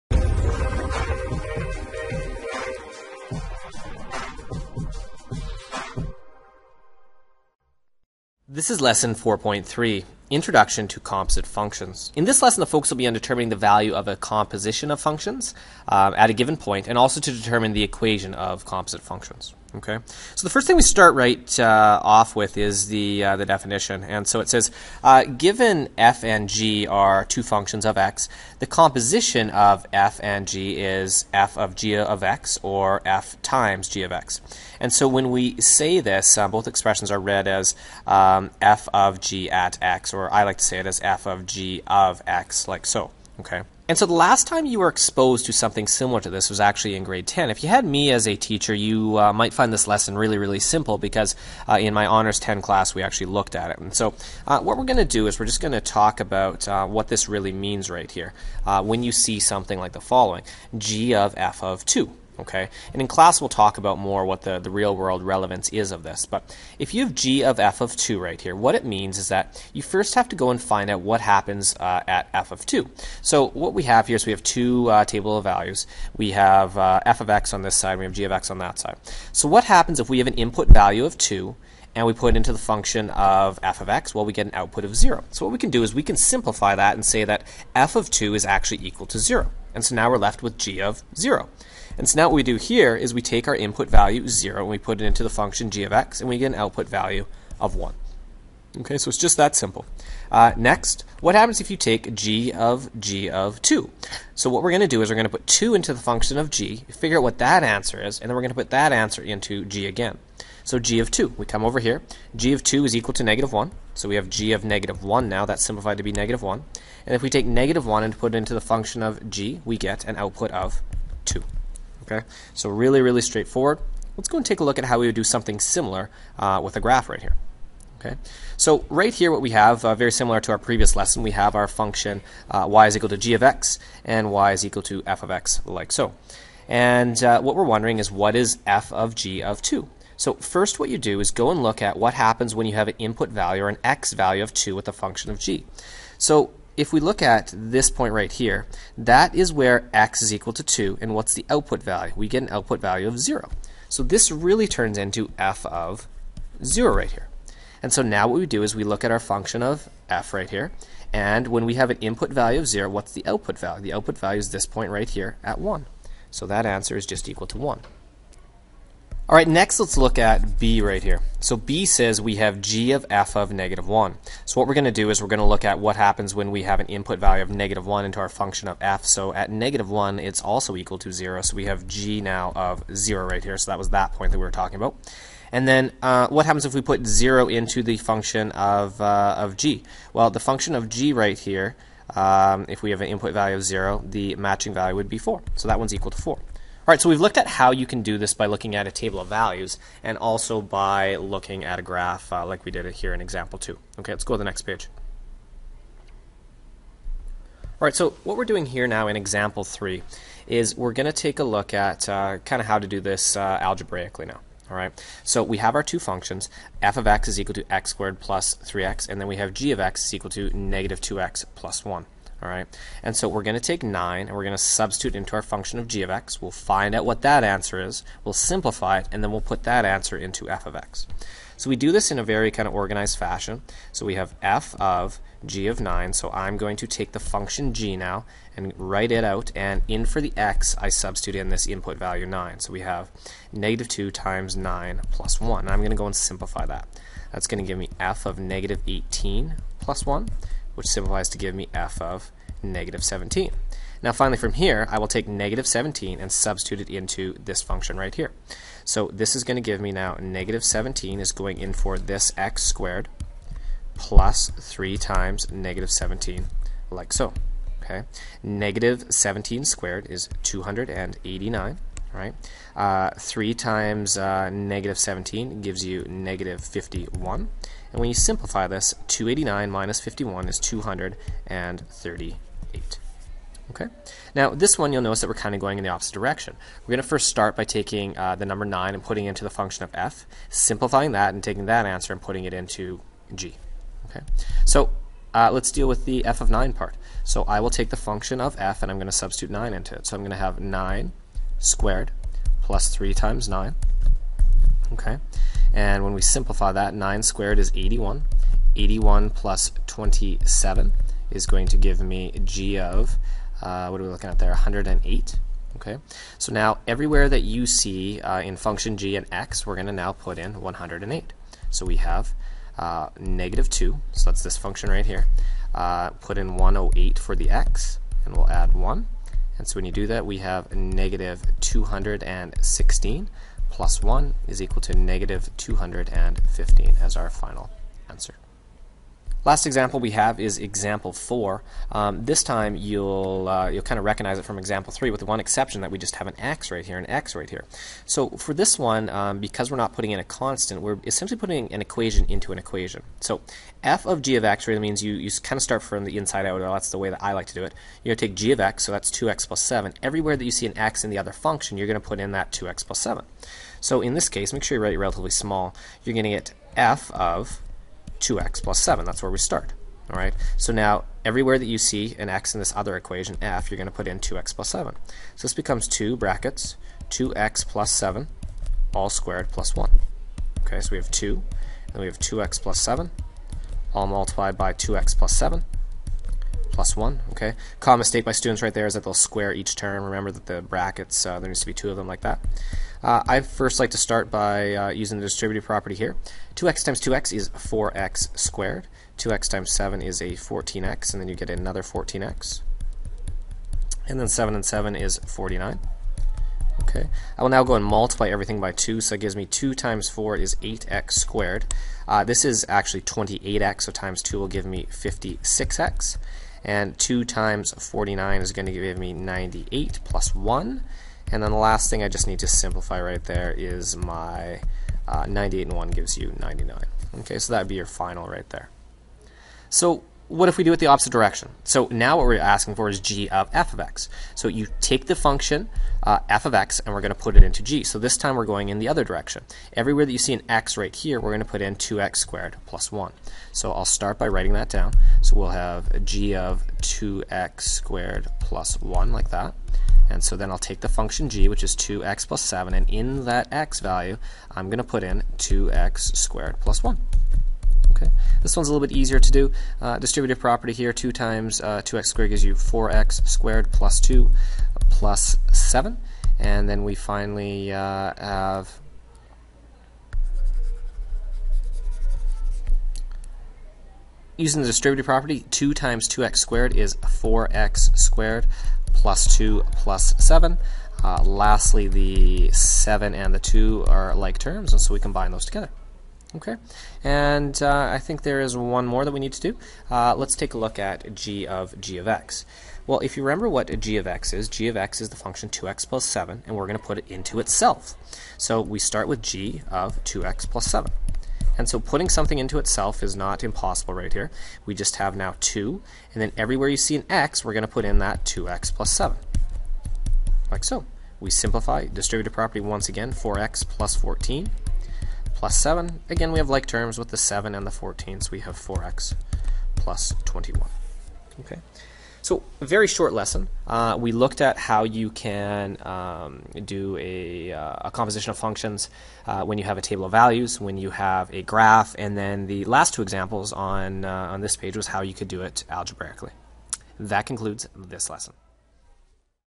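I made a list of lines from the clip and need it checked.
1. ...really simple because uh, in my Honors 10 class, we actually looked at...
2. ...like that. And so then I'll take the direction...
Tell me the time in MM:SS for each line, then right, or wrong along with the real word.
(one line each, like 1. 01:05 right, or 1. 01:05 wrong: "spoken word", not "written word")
1. 00:50 right
2. 07:29 wrong: "function", not "direction".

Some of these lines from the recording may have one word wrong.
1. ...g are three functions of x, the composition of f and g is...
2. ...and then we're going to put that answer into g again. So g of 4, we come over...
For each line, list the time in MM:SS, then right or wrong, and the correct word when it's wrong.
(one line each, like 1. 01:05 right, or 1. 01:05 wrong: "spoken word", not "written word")
1. 00:26 wrong: "two", not "three"
2. 01:48 wrong: "2", not "4".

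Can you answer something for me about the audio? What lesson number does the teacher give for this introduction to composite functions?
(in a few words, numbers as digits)
4.3.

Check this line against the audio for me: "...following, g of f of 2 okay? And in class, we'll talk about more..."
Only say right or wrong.
right.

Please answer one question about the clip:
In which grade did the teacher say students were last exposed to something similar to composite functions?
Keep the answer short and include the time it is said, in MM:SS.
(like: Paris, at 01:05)
grade 10, at 00:47.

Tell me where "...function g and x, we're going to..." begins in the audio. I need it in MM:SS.
05:18.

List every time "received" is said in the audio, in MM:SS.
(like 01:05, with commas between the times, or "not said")
not said.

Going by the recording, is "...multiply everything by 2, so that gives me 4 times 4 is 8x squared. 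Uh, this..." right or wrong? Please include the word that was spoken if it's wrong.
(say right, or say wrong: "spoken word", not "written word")
wrong: "2", not "4".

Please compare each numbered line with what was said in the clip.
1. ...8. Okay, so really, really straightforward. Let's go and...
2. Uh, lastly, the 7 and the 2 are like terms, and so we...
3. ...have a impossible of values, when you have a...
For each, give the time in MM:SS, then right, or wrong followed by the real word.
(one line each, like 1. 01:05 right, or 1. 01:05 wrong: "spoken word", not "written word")
1. 02:01 wrong: "2", not "8"
2. 08:01 right
3. 08:49 wrong: "table", not "impossible".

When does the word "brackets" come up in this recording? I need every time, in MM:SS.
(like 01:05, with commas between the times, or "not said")
06:16, 06:30.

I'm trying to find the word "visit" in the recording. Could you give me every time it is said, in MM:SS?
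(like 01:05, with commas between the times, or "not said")
not said.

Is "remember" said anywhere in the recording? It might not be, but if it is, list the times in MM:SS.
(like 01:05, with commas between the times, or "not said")
06:30, 08:13.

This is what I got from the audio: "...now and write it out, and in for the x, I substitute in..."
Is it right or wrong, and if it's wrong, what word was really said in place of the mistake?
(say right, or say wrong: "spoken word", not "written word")
right.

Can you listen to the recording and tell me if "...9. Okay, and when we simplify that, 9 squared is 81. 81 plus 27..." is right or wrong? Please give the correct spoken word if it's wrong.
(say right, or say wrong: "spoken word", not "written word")
right.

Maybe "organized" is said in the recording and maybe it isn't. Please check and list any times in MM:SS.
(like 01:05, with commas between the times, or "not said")
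03:52.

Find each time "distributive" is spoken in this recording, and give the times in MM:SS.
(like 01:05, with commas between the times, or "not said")
06:35, 07:39, 07:54, 08:31.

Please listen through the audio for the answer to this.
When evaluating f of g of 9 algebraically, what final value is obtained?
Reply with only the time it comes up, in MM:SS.
04:40.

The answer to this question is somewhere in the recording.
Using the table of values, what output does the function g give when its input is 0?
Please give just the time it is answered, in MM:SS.
01:36.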